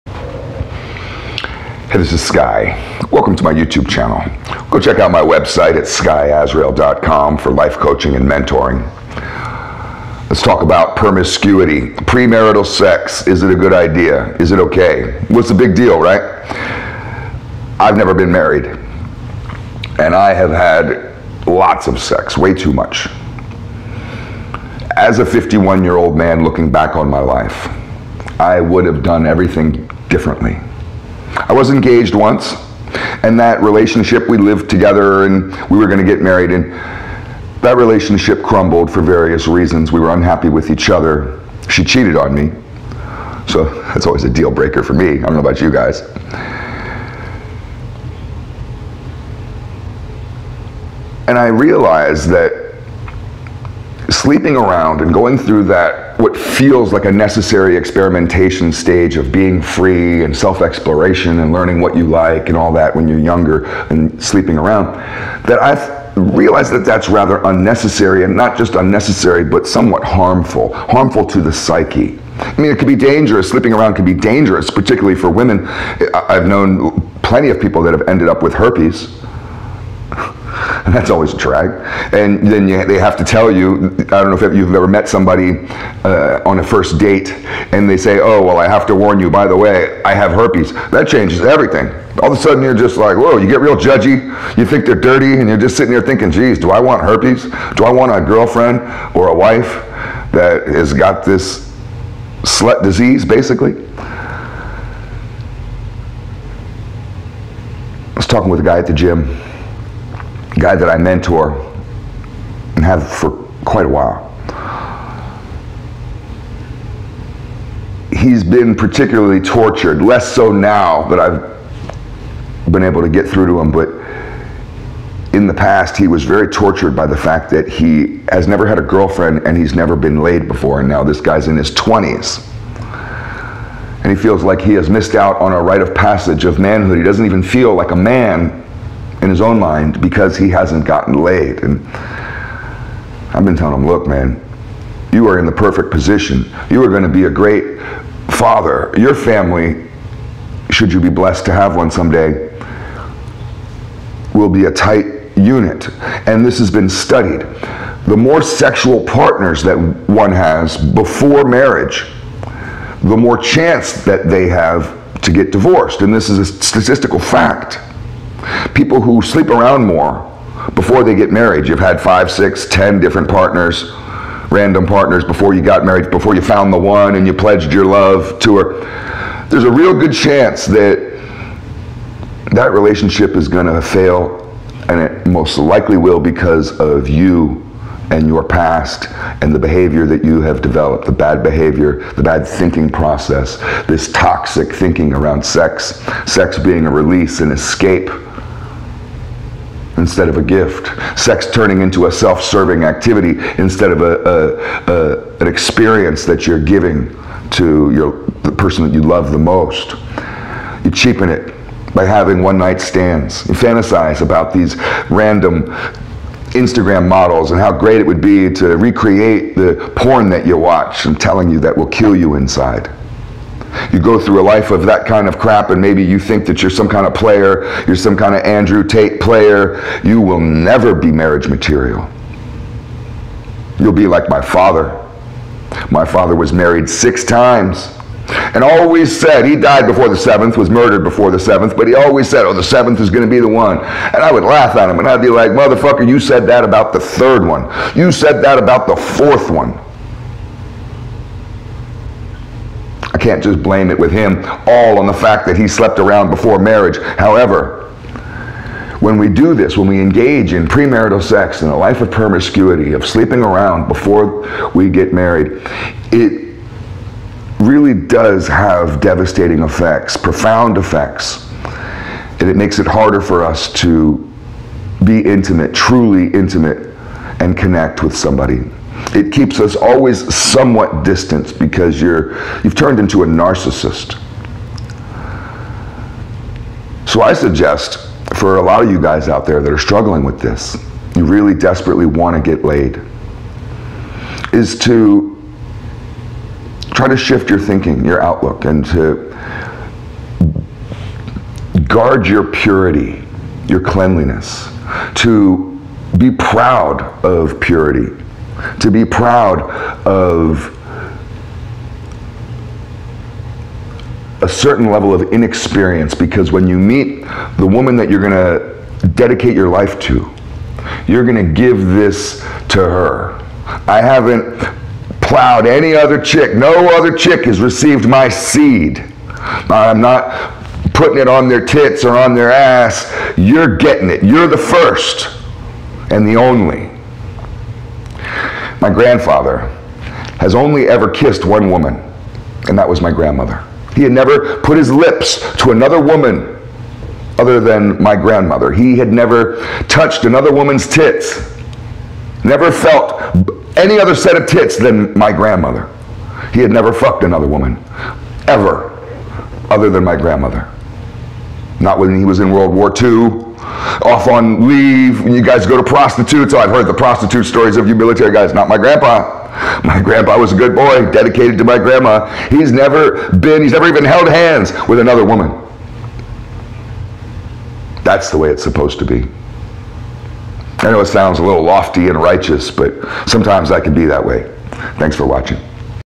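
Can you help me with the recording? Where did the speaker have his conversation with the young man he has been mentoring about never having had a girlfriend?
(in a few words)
the gym.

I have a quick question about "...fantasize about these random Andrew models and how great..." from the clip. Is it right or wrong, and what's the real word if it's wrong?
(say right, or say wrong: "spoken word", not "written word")
wrong: "Instagram", not "Andrew".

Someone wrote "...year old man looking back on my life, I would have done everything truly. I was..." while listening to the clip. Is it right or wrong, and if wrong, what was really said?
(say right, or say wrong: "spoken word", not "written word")
wrong: "differently", not "truly".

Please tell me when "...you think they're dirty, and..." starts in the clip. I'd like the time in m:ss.
1:34.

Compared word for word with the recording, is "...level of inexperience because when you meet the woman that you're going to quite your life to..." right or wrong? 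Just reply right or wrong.
wrong.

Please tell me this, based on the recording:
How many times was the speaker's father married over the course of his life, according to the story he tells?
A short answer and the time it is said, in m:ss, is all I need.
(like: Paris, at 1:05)
6, at 3:56.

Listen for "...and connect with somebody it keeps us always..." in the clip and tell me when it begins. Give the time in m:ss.
4:37.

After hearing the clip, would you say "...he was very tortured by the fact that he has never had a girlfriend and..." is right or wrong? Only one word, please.
right.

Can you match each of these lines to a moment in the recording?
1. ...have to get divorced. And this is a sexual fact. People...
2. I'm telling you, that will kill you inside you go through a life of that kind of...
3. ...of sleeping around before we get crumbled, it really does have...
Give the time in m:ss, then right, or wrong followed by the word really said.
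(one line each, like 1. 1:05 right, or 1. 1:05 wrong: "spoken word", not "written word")
1. 2:44 wrong: "statistical", not "sexual"
2. 3:41 right
3. 4:22 wrong: "married", not "crumbled".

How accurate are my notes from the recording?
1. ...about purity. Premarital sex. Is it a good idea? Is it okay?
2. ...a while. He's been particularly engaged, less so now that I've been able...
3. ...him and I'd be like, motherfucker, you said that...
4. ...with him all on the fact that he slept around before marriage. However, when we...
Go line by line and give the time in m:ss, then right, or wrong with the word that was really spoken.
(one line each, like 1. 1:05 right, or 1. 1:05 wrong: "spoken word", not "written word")
1. 0:10 wrong: "promiscuity", not "purity"
2. 1:53 wrong: "tortured", not "engaged"
3. 4:04 right
4. 4:13 right.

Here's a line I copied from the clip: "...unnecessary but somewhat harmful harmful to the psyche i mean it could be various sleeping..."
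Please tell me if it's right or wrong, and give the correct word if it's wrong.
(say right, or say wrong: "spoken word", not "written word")
wrong: "dangerous", not "various".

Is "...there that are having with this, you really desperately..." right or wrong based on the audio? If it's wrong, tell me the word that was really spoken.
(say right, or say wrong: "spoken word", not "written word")
wrong: "struggling", not "having".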